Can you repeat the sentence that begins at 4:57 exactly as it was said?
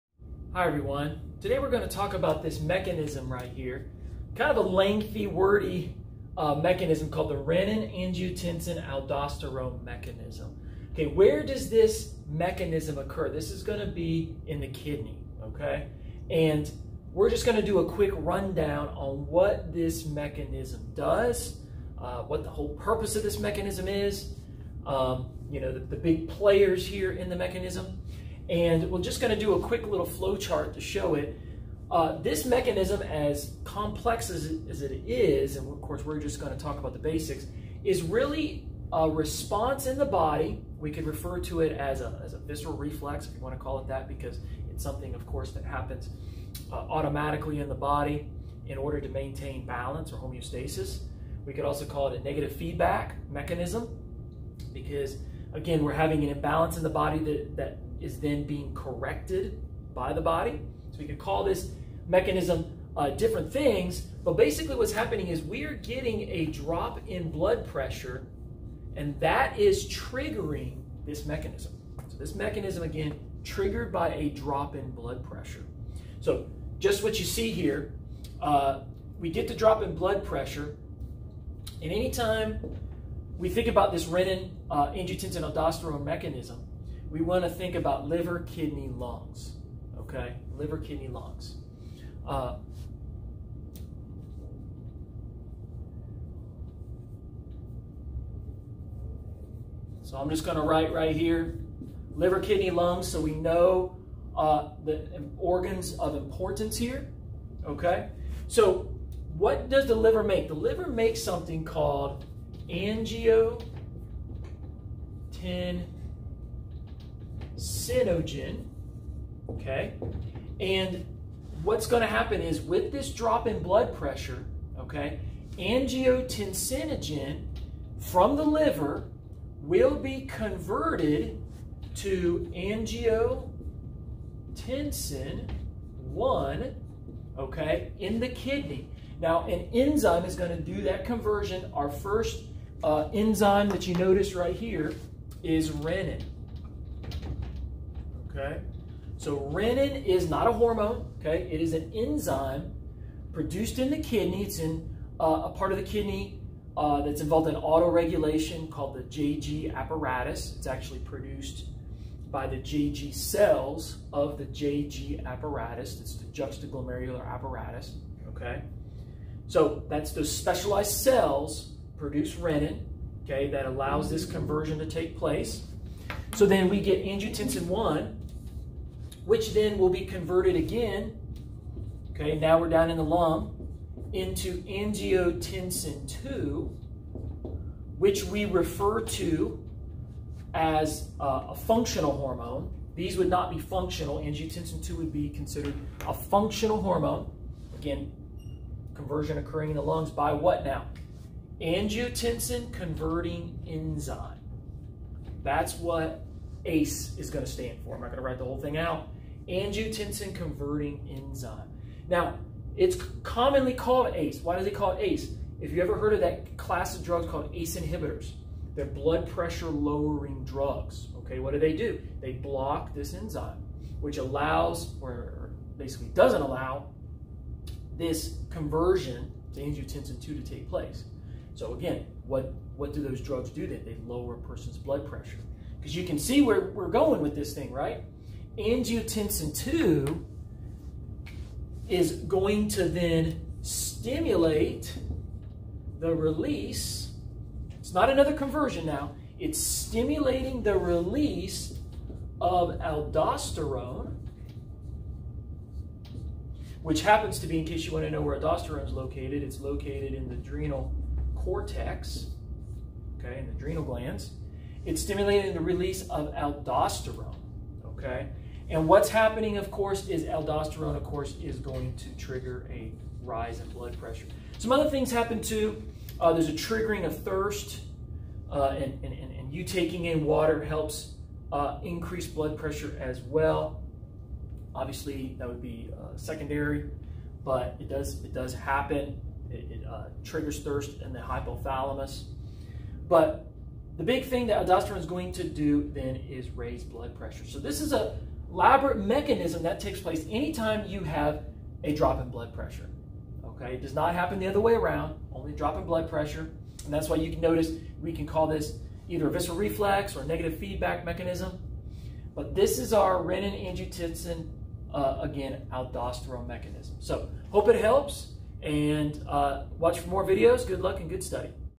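So this is a elaborate mechanism that takes place anytime you have a drop in blood pressure.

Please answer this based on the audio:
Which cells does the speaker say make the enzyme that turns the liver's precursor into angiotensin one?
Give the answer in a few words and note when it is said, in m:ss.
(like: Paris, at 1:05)
JG cells, at 2:42.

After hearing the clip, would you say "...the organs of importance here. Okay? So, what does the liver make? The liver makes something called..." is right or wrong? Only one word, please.
right.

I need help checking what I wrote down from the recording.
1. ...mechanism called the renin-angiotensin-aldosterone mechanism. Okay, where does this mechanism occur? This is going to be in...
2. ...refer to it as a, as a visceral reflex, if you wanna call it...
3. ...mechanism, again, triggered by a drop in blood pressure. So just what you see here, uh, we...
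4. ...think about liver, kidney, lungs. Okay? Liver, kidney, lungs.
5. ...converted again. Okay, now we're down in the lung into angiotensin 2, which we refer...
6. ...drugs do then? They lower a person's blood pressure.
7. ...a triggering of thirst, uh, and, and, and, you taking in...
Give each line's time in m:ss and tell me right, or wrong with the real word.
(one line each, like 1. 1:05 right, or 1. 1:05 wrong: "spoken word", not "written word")
1. 0:06 right
2. 0:41 right
3. 1:12 right
4. 1:27 right
5. 3:00 right
6. 3:53 right
7. 4:36 right.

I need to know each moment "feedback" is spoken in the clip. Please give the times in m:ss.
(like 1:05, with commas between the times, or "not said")
0:52, 5:10.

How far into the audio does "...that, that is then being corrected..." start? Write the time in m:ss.
0:57.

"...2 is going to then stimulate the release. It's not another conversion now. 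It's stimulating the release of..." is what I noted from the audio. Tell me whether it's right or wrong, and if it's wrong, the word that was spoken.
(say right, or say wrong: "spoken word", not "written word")
right.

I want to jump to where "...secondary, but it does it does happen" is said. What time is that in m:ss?
4:46.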